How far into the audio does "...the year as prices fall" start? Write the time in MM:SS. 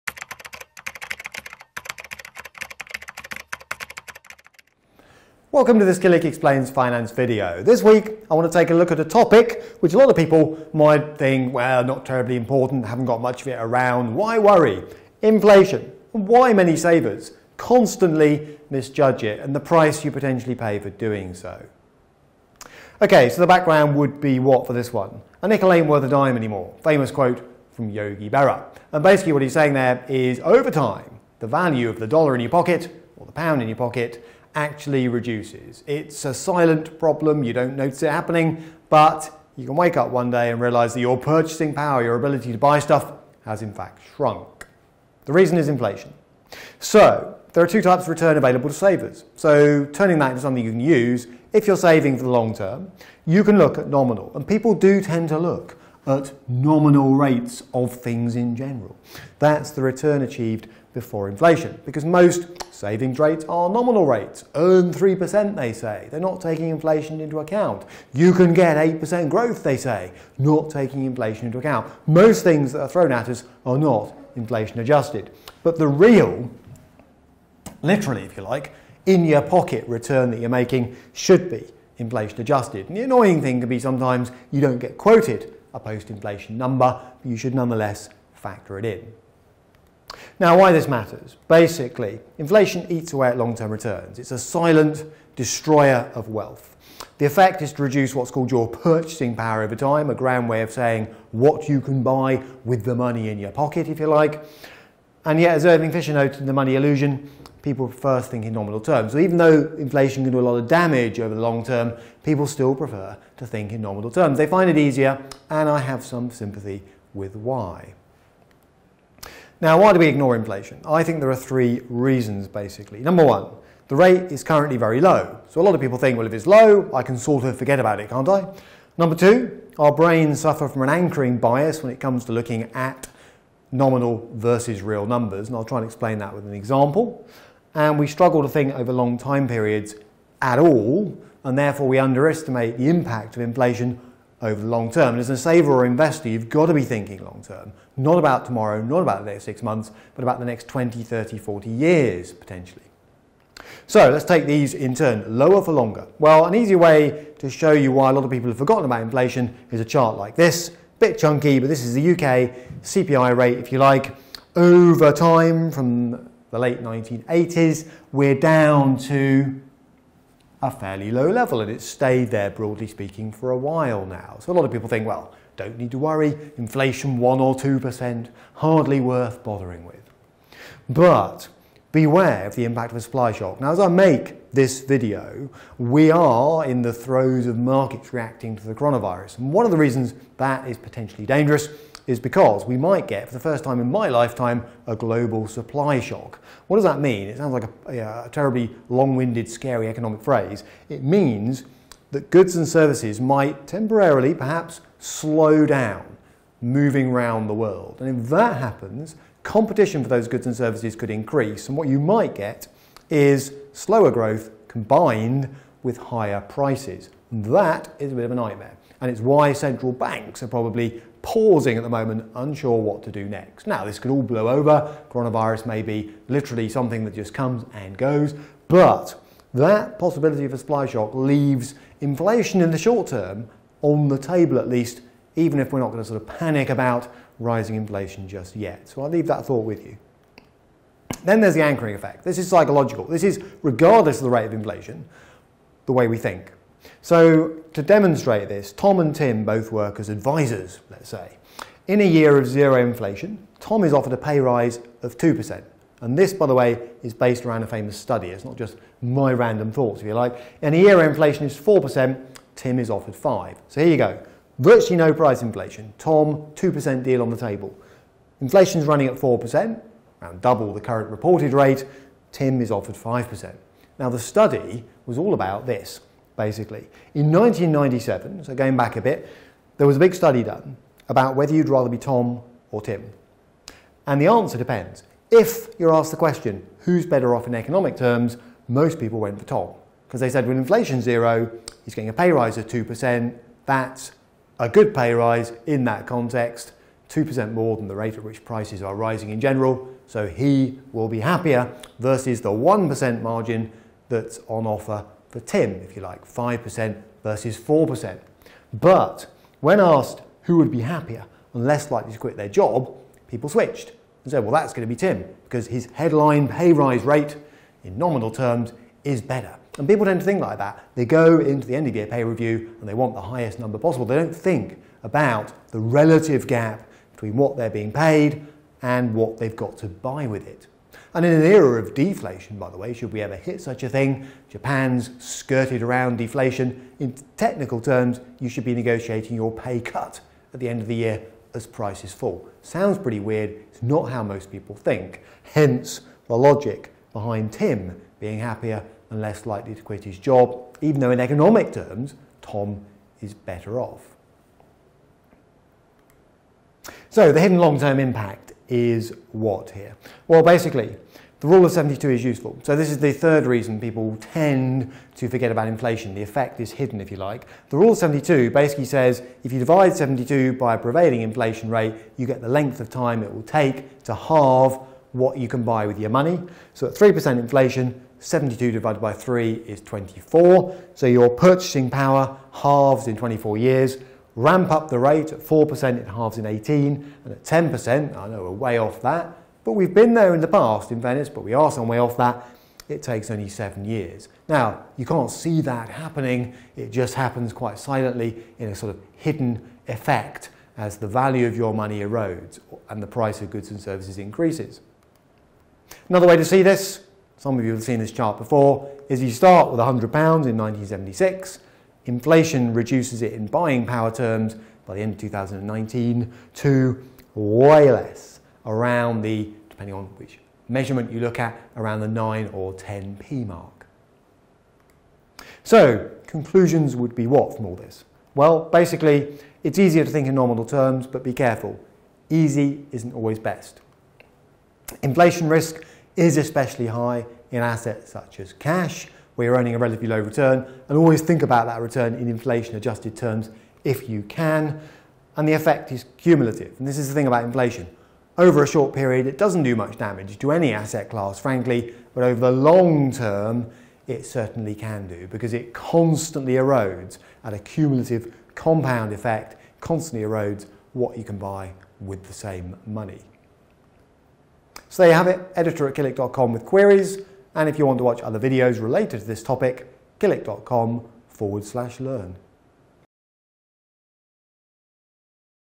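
05:40.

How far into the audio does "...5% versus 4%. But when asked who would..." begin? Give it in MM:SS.
05:06.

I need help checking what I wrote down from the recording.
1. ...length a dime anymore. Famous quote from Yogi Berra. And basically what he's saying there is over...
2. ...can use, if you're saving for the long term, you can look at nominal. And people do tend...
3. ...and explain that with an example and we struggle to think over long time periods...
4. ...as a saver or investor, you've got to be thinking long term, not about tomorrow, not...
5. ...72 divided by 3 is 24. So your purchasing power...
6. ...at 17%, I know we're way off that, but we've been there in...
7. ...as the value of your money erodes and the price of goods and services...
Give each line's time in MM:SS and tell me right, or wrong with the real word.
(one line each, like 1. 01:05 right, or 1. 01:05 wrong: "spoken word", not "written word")
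1. 00:25 wrong: "worth", not "length"
2. 00:50 right
3. 02:15 right
4. 02:25 right
5. 06:18 right
6. 06:27 wrong: "10", not "17"
7. 06:40 right.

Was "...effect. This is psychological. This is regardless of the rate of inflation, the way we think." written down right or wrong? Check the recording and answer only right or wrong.
right.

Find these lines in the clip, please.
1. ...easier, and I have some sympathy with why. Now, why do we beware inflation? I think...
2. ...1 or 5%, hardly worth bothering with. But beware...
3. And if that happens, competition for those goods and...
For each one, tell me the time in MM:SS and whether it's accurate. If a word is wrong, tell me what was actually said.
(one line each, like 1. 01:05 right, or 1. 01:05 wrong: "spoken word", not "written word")
1. 01:54 wrong: "ignore", not "beware"
2. 02:57 wrong: "2", not "5"
3. 03:27 right.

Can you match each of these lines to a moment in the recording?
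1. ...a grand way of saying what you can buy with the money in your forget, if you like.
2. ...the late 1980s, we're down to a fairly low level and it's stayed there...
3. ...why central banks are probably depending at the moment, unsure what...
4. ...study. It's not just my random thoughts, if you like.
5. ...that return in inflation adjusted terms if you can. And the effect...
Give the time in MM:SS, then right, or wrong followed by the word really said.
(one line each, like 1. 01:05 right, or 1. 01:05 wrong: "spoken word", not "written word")
1. 01:40 wrong: "pocket", not "forget"
2. 02:46 right
3. 03:39 wrong: "pausing", not "depending"
4. 04:17 right
5. 07:21 right.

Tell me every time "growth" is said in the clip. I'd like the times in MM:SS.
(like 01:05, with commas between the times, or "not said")
01:09, 03:34.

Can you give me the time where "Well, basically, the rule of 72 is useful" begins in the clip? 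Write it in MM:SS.
06:00.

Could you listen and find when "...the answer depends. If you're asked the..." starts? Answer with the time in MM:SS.
04:44.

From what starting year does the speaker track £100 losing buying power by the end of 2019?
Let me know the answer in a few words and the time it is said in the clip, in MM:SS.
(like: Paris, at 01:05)
1976, at 06:50.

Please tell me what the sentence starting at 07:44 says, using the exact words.
So there you have it, editor at killik.com with queries.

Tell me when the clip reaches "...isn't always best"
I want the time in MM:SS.
07:12.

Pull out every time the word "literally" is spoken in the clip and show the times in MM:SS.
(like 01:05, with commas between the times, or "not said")
01:17, 03:46.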